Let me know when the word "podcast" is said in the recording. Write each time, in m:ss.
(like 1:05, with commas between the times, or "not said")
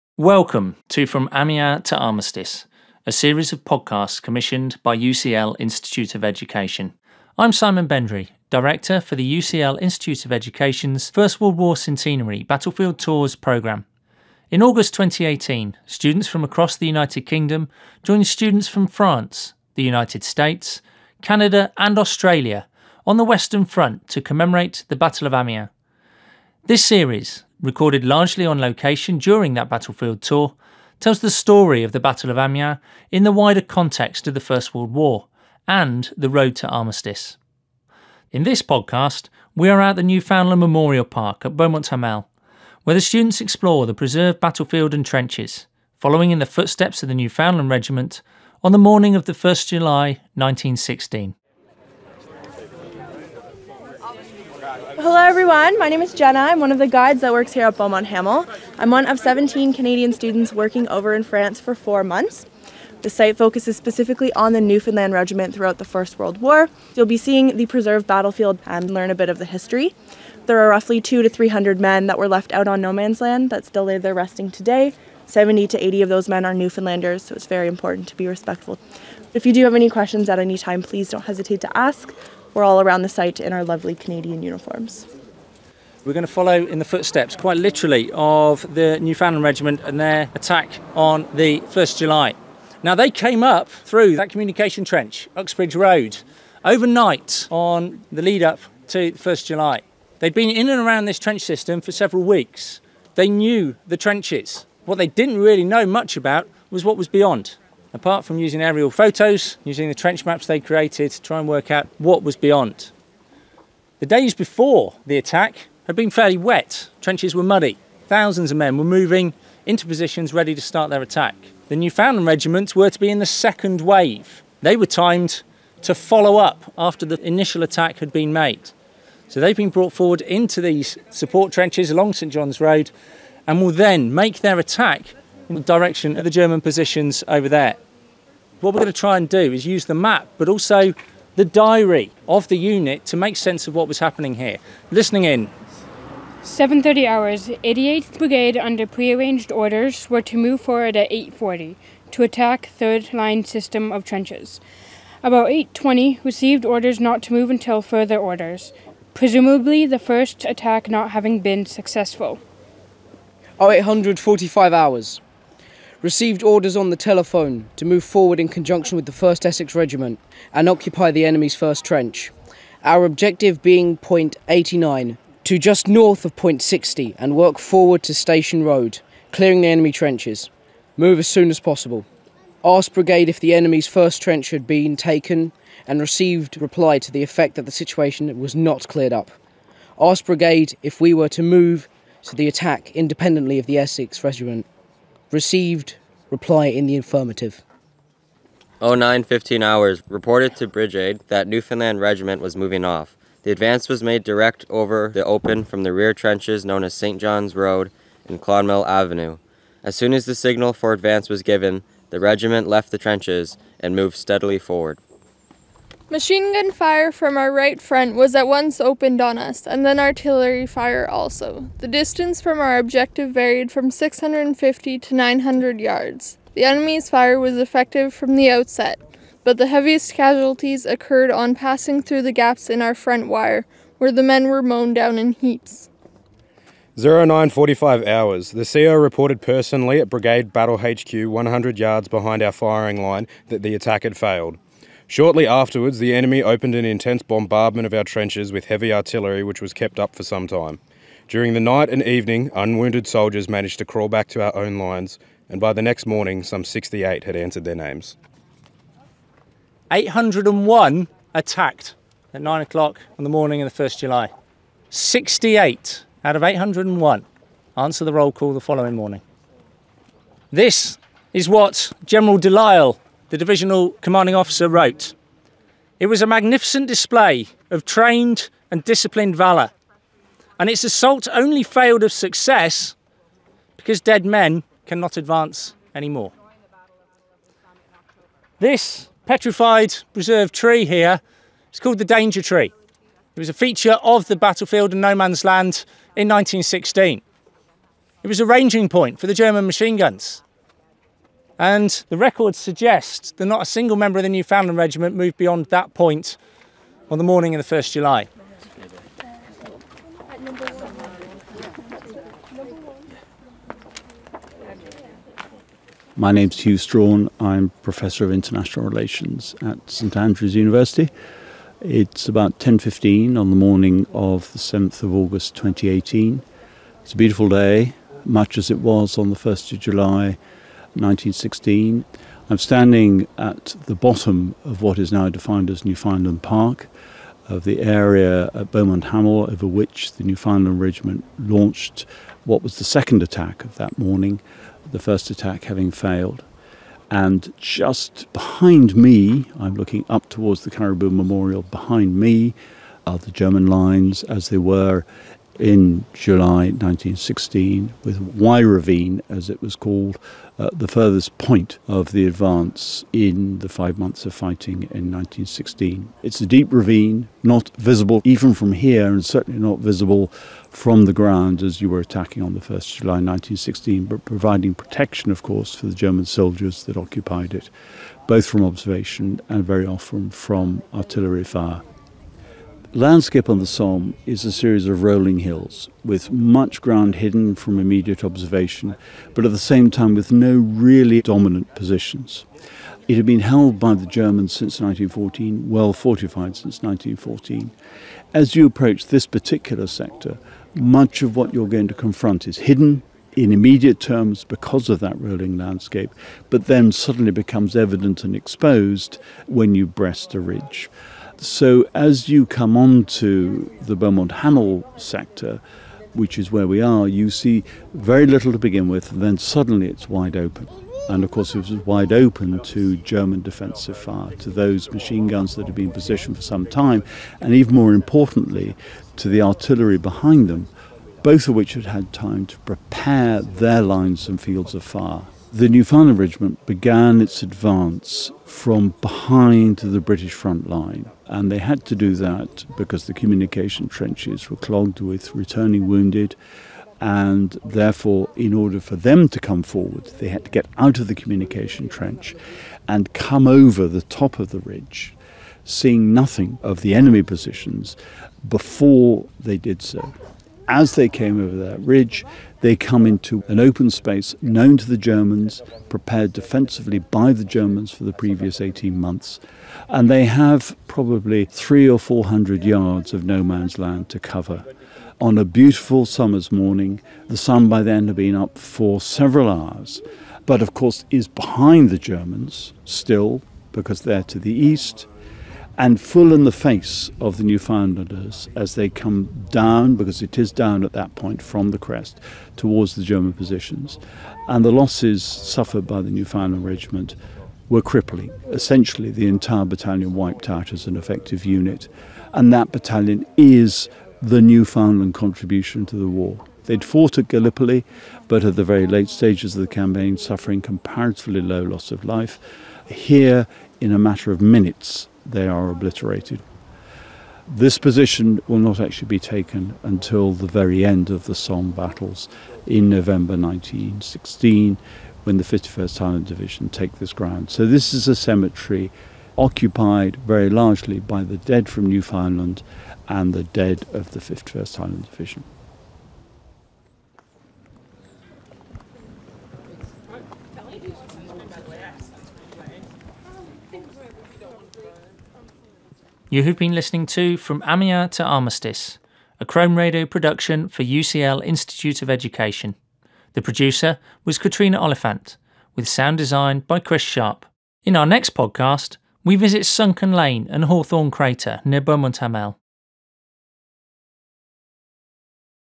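0:03, 0:38, 9:18.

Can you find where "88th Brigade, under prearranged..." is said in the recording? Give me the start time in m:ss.
2:27.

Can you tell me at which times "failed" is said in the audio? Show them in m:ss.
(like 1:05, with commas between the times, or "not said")
4:04, 4:41, 5:45.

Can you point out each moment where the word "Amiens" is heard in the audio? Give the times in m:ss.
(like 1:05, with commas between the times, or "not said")
0:01, 0:25, 0:32, 9:07.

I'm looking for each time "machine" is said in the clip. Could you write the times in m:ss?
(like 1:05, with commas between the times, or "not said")
3:36, 4:59, 7:04.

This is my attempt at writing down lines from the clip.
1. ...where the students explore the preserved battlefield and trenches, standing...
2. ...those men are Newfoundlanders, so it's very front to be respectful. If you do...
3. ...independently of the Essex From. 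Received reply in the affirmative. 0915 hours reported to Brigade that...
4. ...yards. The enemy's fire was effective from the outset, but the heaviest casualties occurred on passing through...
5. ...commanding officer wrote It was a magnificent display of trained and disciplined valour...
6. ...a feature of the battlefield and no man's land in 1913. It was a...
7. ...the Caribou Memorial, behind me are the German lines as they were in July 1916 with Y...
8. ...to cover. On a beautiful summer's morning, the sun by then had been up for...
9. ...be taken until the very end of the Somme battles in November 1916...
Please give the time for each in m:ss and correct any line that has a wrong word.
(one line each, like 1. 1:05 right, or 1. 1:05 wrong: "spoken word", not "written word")
1. 0:42 wrong: "following", not "standing"
2. 1:16 wrong: "important", not "front"
3. 3:12 wrong: "Regiment", not "From"
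4. 3:45 right
5. 4:34 right
6. 4:53 wrong: "1916", not "1913"
7. 5:50 right
8. 7:54 right
9. 8:39 right.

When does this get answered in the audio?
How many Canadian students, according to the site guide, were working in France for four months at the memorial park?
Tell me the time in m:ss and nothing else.
0:59.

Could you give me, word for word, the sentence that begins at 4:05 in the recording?
Shortly afterwards, the enemy opened an intense bombardment of our trenches with heavy artillery, which was kept up for some time.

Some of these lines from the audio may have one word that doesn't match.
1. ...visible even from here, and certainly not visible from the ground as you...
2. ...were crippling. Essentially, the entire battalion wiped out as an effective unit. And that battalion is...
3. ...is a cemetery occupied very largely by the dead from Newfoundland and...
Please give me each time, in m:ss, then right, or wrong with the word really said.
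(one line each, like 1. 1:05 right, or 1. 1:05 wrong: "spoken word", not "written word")
1. 6:07 right
2. 8:17 right
3. 8:47 right.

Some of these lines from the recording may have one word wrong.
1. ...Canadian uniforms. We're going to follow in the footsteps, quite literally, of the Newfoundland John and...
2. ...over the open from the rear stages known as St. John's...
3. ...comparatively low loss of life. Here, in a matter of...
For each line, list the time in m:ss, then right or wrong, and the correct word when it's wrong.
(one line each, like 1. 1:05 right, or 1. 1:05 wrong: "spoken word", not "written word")
1. 1:23 wrong: "Regiment", not "John"
2. 3:24 wrong: "trenches", not "stages"
3. 8:30 right.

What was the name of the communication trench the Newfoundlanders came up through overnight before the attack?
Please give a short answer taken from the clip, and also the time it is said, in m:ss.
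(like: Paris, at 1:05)
Uxbridge Road, at 1:35.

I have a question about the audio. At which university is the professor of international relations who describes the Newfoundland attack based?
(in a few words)
St Andrews University.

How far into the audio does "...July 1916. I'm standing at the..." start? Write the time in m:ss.
5:29.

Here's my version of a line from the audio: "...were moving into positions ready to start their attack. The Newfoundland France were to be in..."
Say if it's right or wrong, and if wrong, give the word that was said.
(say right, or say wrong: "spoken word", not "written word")
wrong: "Regiment", not "France".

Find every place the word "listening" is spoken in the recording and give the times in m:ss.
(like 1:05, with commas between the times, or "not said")
2:24, 9:06.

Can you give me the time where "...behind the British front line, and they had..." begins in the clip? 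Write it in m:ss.
7:19.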